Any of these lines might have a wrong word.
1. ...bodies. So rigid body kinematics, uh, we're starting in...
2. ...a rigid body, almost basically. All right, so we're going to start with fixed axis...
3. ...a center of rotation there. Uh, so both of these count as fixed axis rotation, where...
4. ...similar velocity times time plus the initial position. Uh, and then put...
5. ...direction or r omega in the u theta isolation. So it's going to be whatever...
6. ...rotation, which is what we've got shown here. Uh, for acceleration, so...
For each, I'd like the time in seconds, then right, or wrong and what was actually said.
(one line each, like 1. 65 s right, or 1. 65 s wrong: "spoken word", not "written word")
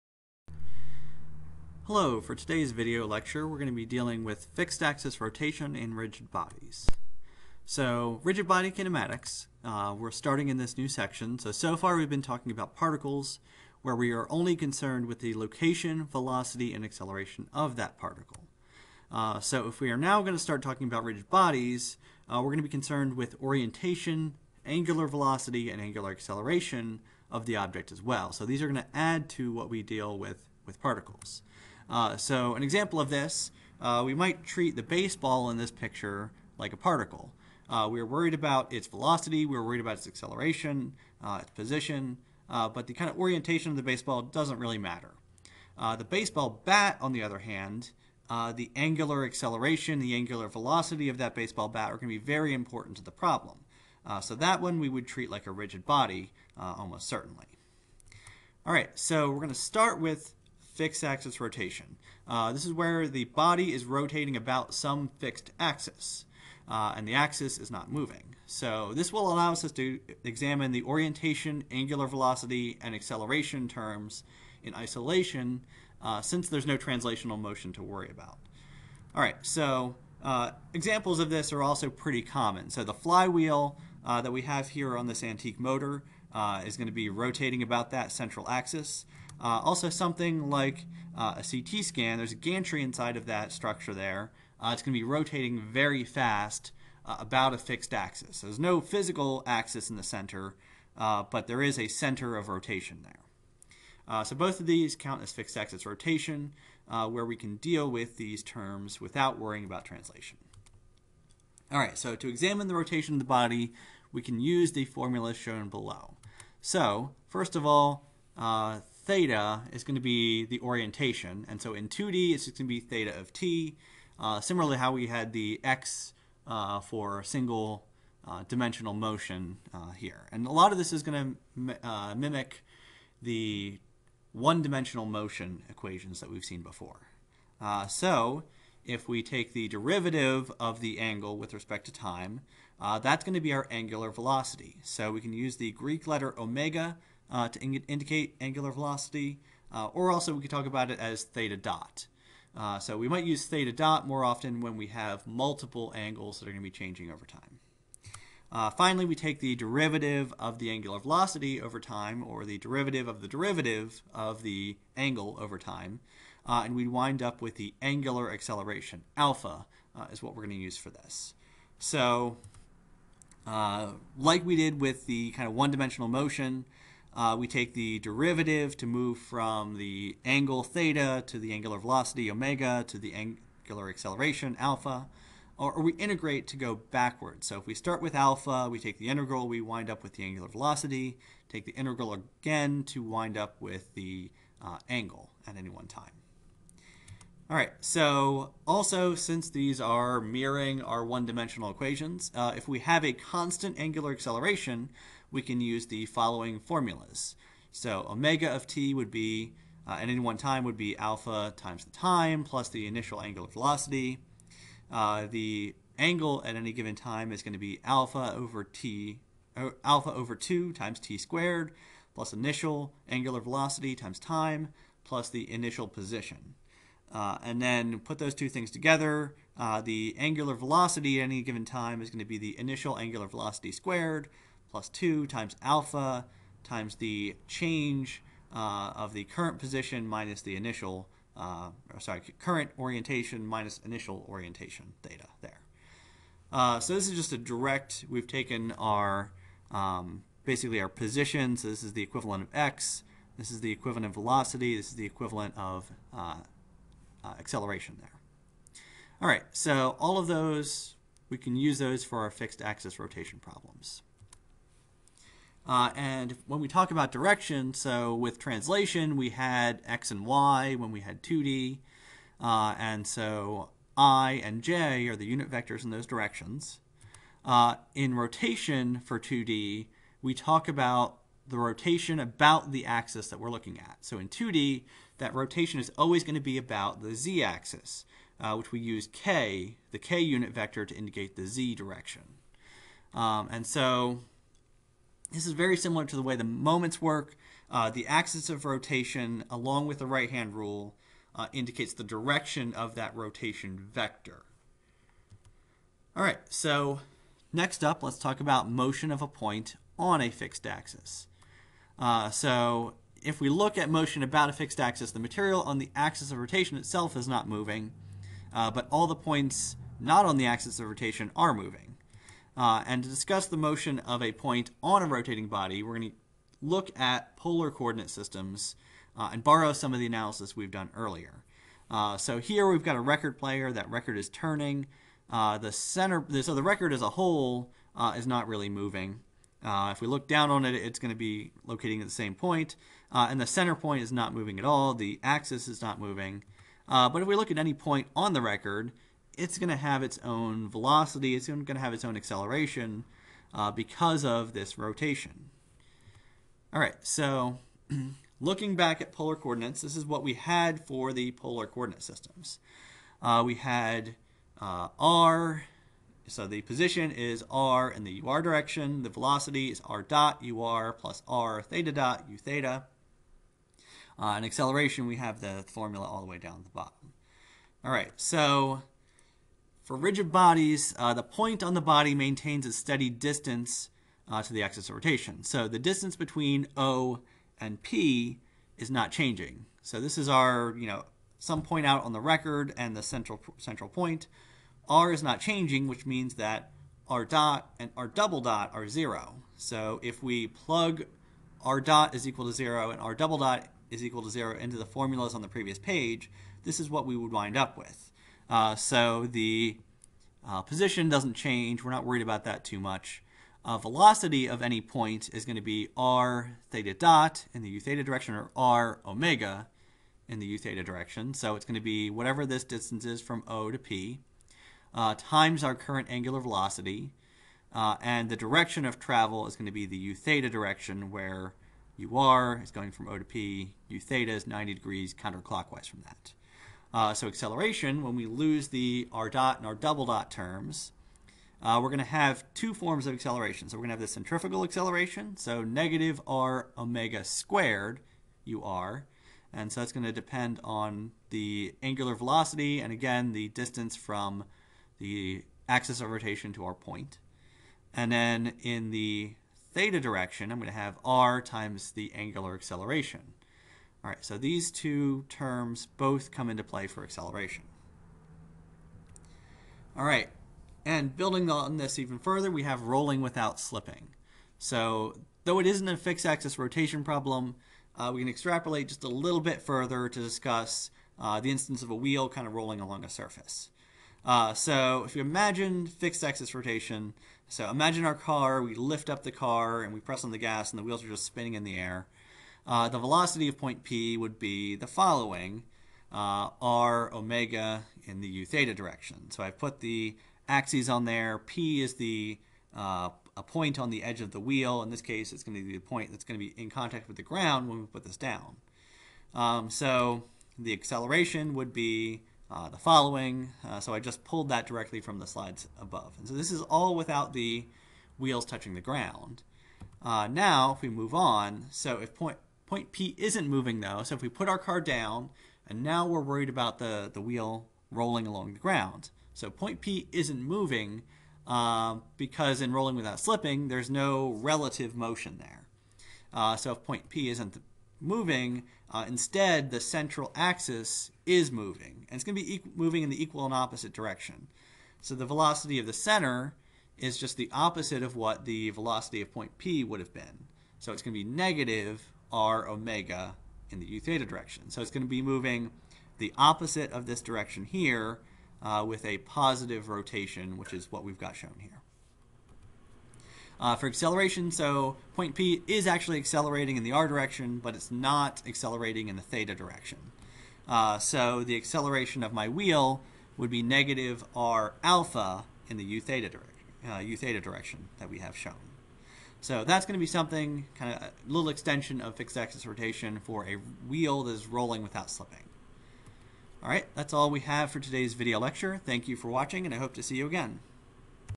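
1. 6 s right
2. 55 s wrong: "certainly", not "basically"
3. 101 s right
4. 223 s wrong: "angular", not "similar"
5. 418 s wrong: "direction", not "isolation"
6. 559 s right.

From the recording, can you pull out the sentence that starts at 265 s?
Uh, and when we talk about direction, so with translation, we had x and y when we had 2D.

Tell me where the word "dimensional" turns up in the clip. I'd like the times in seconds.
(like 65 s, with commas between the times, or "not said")
128 s, 134 s, 175 s, 201 s.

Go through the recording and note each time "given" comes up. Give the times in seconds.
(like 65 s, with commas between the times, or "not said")
216 s, 231 s.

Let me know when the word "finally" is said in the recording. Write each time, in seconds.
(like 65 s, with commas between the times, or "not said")
158 s.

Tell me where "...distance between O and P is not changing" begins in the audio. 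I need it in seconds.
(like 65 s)
385 s.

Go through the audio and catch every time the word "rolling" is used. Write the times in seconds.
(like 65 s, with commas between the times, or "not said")
472 s, 482 s, 527 s, 532 s, 584 s.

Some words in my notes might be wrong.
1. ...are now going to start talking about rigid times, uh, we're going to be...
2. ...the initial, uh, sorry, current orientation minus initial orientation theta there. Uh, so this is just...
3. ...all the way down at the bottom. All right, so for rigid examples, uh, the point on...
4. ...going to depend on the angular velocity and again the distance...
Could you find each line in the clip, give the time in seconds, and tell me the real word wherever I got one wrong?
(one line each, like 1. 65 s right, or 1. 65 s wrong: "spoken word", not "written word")
1. 19 s wrong: "bodies", not "times"
2. 240 s right
3. 376 s wrong: "bodies", not "examples"
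4. 449 s right.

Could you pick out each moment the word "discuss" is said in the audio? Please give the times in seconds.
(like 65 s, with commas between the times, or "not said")
323 s, 480 s.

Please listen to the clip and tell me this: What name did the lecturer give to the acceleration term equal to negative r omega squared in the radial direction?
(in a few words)
centrifugal acceleration.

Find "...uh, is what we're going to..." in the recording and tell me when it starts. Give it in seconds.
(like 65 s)
169 s.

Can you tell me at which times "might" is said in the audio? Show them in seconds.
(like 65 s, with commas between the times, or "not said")
34 s, 153 s.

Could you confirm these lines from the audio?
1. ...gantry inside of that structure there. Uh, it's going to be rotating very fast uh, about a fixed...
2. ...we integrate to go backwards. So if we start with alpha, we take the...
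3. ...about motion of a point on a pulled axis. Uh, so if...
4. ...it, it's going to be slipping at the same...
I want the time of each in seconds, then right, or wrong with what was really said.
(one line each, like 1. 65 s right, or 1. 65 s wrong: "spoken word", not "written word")
1. 92 s right
2. 185 s right
3. 308 s wrong: "fixed", not "pulled"
4. 340 s wrong: "locating", not "slipping".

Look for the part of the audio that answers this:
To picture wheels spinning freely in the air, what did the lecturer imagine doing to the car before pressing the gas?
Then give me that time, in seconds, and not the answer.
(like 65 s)
488 s.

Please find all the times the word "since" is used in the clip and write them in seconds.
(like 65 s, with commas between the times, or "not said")
76 s, 199 s.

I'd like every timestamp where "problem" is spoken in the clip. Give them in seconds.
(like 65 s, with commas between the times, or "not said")
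53 s, 263 s, 477 s.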